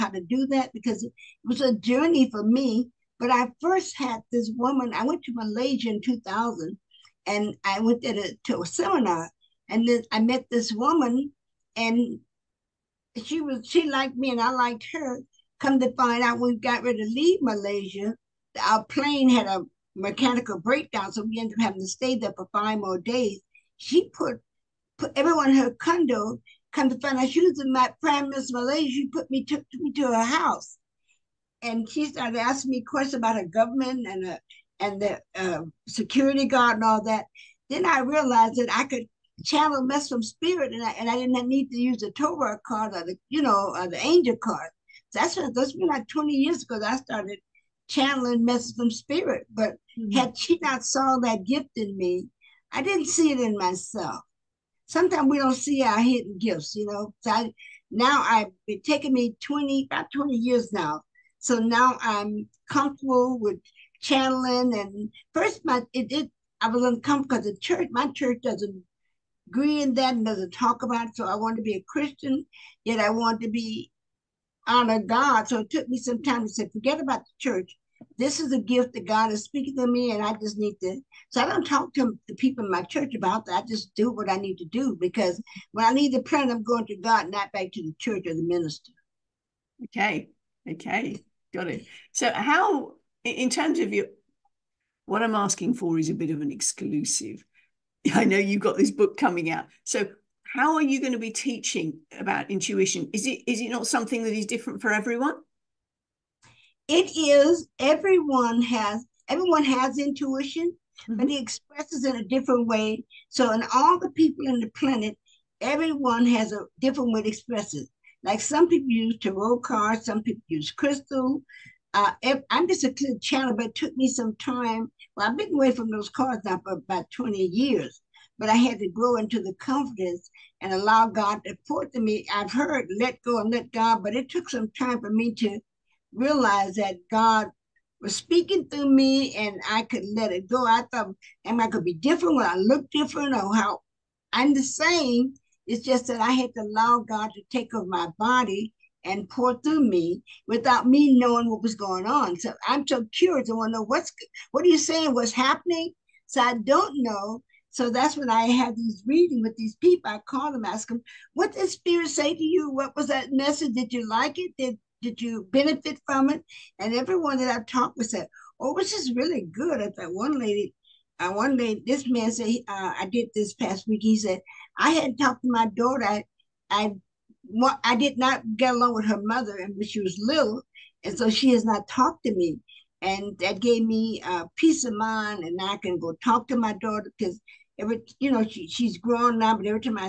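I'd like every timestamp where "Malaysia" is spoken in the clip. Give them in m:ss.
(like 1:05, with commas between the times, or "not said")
0:05, 0:17, 0:28.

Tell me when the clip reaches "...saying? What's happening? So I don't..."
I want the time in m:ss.
2:34.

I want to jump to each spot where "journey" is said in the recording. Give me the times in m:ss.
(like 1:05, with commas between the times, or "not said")
0:01.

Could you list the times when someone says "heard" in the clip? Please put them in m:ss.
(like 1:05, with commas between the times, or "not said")
2:12.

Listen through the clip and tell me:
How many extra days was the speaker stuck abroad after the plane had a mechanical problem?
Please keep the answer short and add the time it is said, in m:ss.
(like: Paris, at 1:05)
5, at 0:22.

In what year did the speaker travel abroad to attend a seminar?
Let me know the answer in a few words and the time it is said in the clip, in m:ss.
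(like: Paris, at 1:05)
2000, at 0:06.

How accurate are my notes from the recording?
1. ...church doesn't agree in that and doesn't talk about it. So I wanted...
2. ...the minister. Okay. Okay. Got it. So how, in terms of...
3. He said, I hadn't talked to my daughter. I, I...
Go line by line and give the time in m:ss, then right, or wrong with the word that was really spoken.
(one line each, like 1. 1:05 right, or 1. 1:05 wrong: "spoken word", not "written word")
1. 1:08 right
2. 1:28 right
3. 2:54 right.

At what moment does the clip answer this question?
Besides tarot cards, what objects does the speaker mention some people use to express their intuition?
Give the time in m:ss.
2:00.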